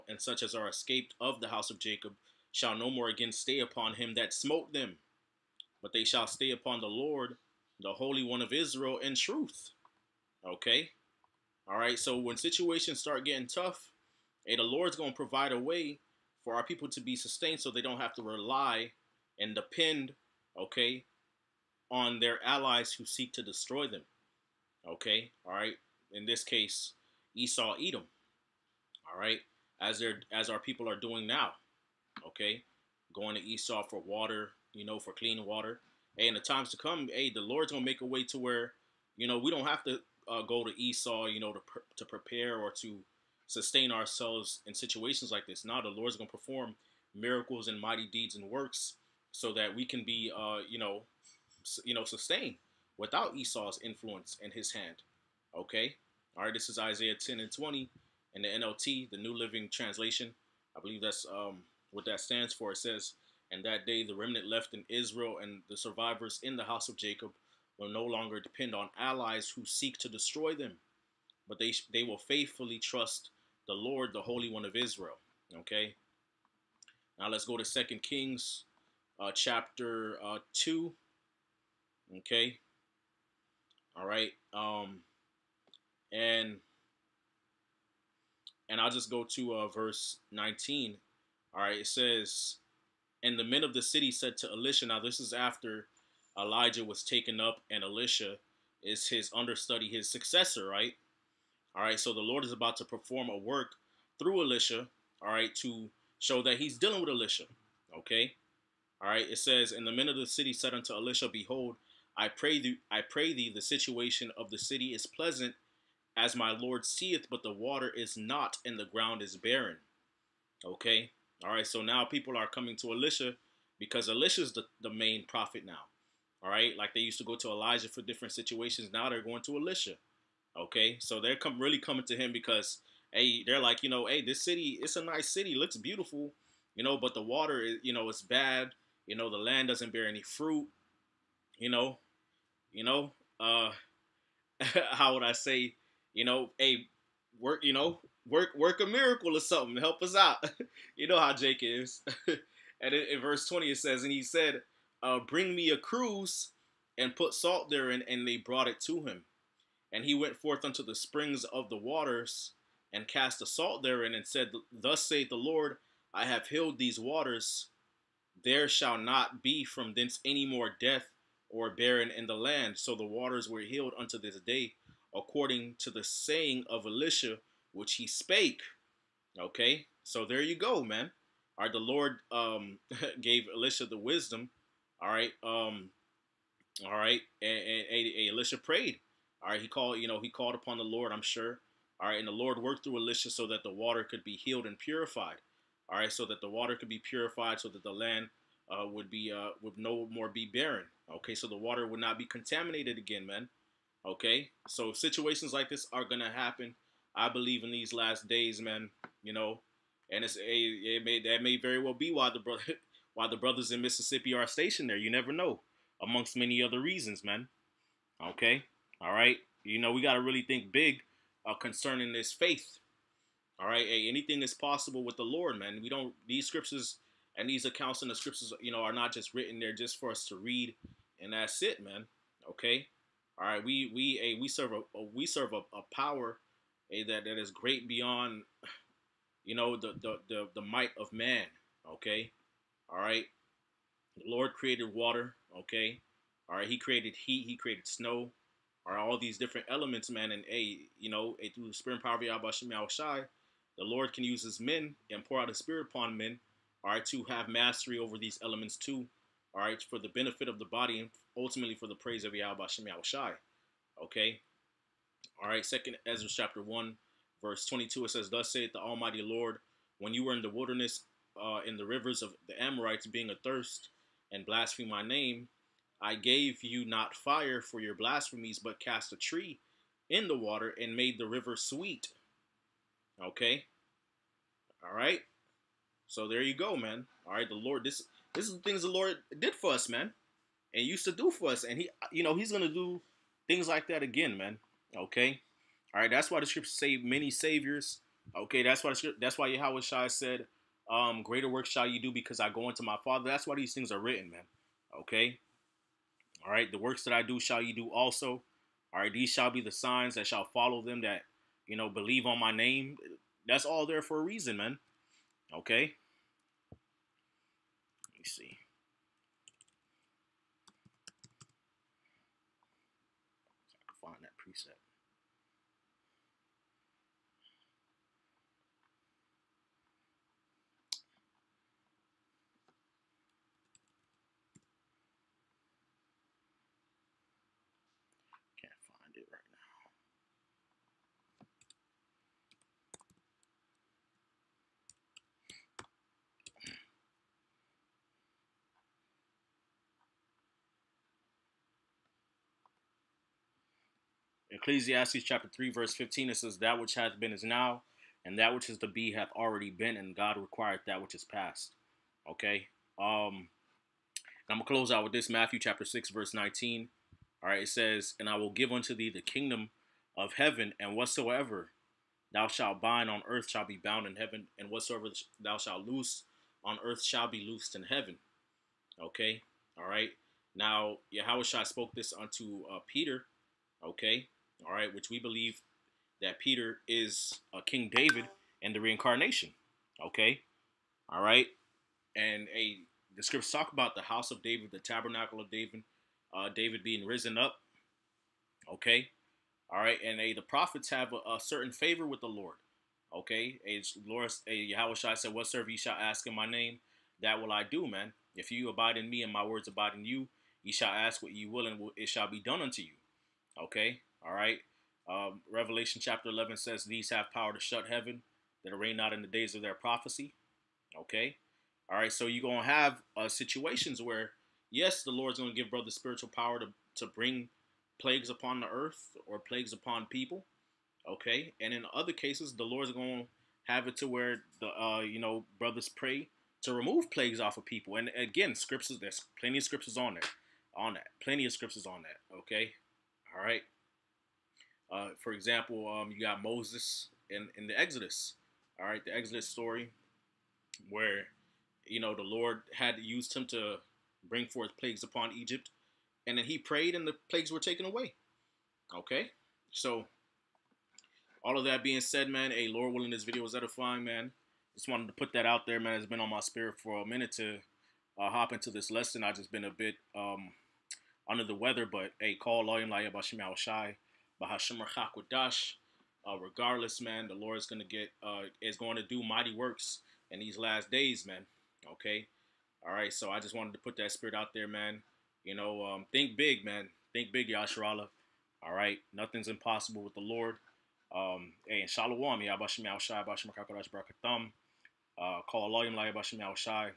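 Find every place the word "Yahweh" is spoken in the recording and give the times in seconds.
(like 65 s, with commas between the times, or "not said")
252 s, 262 s, 299 s, 404 s.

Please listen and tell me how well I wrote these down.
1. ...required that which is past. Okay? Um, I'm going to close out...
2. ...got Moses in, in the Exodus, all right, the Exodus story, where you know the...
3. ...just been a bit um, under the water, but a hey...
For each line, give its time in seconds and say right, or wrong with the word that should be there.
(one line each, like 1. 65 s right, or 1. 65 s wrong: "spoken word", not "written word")
1. 360 s right
2. 446 s right
3. 469 s wrong: "weather", not "water".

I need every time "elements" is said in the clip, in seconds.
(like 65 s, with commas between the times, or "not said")
249 s, 258 s.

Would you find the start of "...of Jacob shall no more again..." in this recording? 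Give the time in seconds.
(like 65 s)
1 s.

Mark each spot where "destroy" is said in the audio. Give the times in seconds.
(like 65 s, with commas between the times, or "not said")
23 s, 70 s.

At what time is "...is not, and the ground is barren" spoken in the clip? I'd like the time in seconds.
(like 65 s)
117 s.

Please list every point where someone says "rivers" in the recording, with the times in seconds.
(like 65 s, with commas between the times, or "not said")
271 s, 281 s.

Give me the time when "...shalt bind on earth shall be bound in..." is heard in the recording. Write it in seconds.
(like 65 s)
372 s.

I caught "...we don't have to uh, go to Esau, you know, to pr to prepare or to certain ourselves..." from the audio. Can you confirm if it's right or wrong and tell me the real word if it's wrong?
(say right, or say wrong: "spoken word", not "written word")
wrong: "sustain", not "certain".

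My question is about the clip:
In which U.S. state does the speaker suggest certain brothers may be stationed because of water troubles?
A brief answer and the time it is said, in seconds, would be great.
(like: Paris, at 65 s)
Mississippi, at 213 s.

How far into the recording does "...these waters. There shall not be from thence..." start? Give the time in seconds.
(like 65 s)
166 s.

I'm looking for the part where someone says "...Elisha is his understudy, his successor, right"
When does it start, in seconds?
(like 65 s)
97 s.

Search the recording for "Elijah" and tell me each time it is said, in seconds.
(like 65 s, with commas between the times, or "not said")
96 s, 127 s.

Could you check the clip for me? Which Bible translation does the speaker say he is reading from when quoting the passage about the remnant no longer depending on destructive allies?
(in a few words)
New Living Translation.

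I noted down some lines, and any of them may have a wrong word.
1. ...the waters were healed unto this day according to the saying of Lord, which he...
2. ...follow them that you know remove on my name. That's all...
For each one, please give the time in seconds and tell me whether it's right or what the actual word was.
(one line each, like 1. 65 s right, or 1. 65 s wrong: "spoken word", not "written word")
1. 172 s wrong: "Elisha", not "Lord"
2. 310 s wrong: "believe", not "remove".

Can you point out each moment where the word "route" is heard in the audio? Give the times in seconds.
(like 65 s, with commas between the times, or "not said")
not said.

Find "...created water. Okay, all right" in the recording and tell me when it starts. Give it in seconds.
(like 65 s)
244 s.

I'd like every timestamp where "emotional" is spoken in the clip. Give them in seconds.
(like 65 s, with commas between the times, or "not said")
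not said.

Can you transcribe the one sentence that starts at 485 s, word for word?
You know, um, think big, man.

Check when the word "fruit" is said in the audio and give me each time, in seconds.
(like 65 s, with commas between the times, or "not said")
140 s.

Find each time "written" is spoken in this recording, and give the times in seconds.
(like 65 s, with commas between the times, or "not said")
229 s, 303 s.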